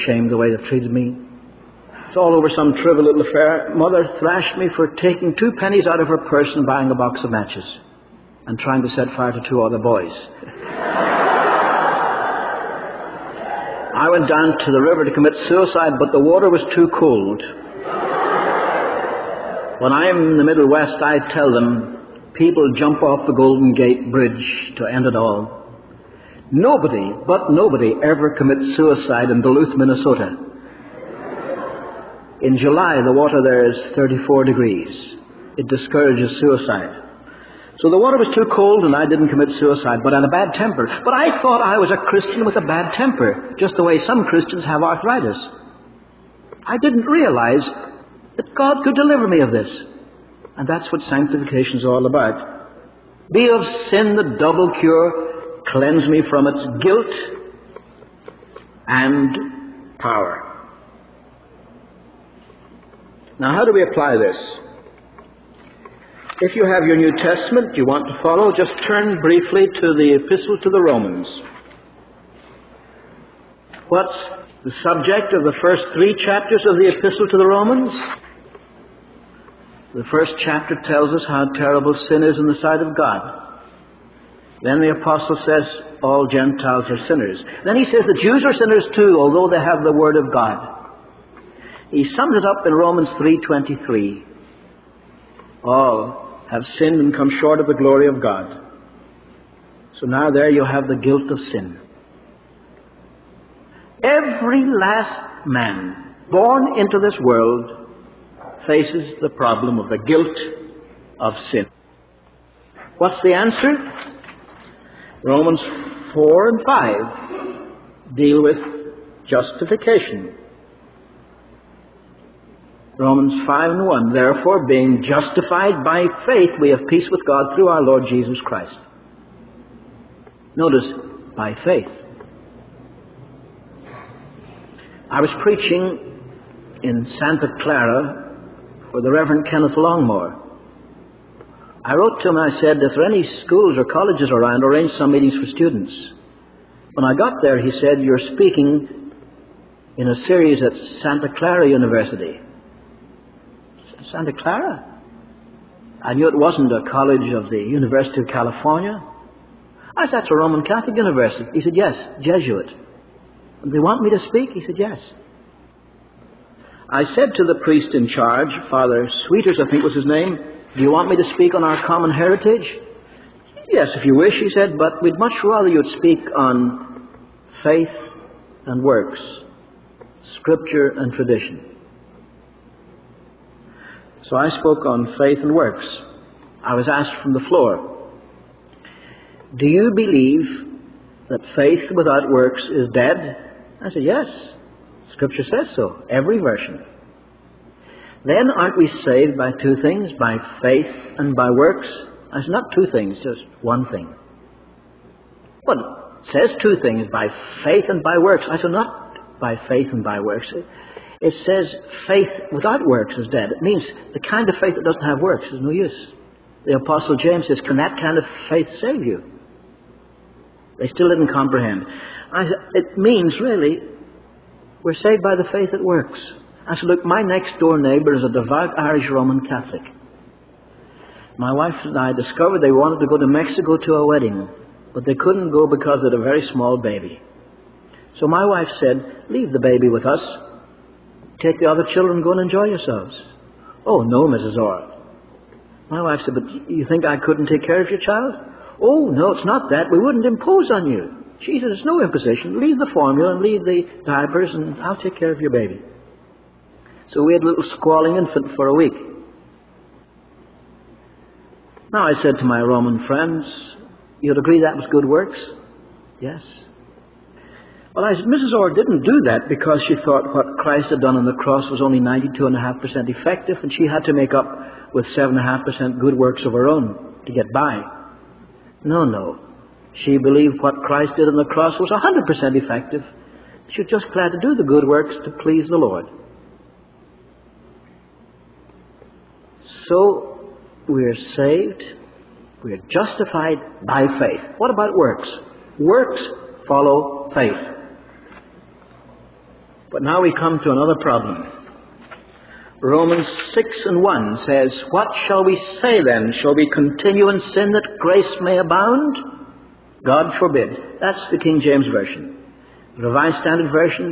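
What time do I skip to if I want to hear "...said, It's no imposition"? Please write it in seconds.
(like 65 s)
251 s.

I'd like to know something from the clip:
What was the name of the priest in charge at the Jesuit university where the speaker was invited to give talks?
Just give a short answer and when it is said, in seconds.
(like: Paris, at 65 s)
Father Sweeters, at 168 s.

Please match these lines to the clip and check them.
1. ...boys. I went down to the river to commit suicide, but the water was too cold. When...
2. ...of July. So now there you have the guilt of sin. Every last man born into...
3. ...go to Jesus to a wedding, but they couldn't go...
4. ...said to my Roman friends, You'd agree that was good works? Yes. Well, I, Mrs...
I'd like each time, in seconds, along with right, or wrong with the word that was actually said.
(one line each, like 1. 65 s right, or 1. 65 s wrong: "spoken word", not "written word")
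1. 9 s right
2. 98 s wrong: "God", not "July"
3. 233 s wrong: "Mexico", not "Jesus"
4. 262 s right.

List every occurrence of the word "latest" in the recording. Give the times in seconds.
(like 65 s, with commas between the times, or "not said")
not said.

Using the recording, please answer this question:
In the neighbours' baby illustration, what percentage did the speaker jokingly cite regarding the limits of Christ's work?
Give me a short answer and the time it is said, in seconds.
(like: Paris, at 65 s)
92.5%, at 271 s.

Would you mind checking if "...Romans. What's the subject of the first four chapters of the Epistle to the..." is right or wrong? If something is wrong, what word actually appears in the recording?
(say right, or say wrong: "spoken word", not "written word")
wrong: "three", not "four".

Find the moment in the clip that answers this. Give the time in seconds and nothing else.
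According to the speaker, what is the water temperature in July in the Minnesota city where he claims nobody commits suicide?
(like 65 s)
33 s.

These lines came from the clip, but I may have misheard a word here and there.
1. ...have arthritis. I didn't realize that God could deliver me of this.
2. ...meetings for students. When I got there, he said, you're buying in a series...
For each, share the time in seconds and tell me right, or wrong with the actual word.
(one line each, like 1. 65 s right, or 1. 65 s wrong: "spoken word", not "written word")
1. 44 s right
2. 145 s wrong: "speaking", not "buying".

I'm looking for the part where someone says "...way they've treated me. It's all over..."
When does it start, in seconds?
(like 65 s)
0 s.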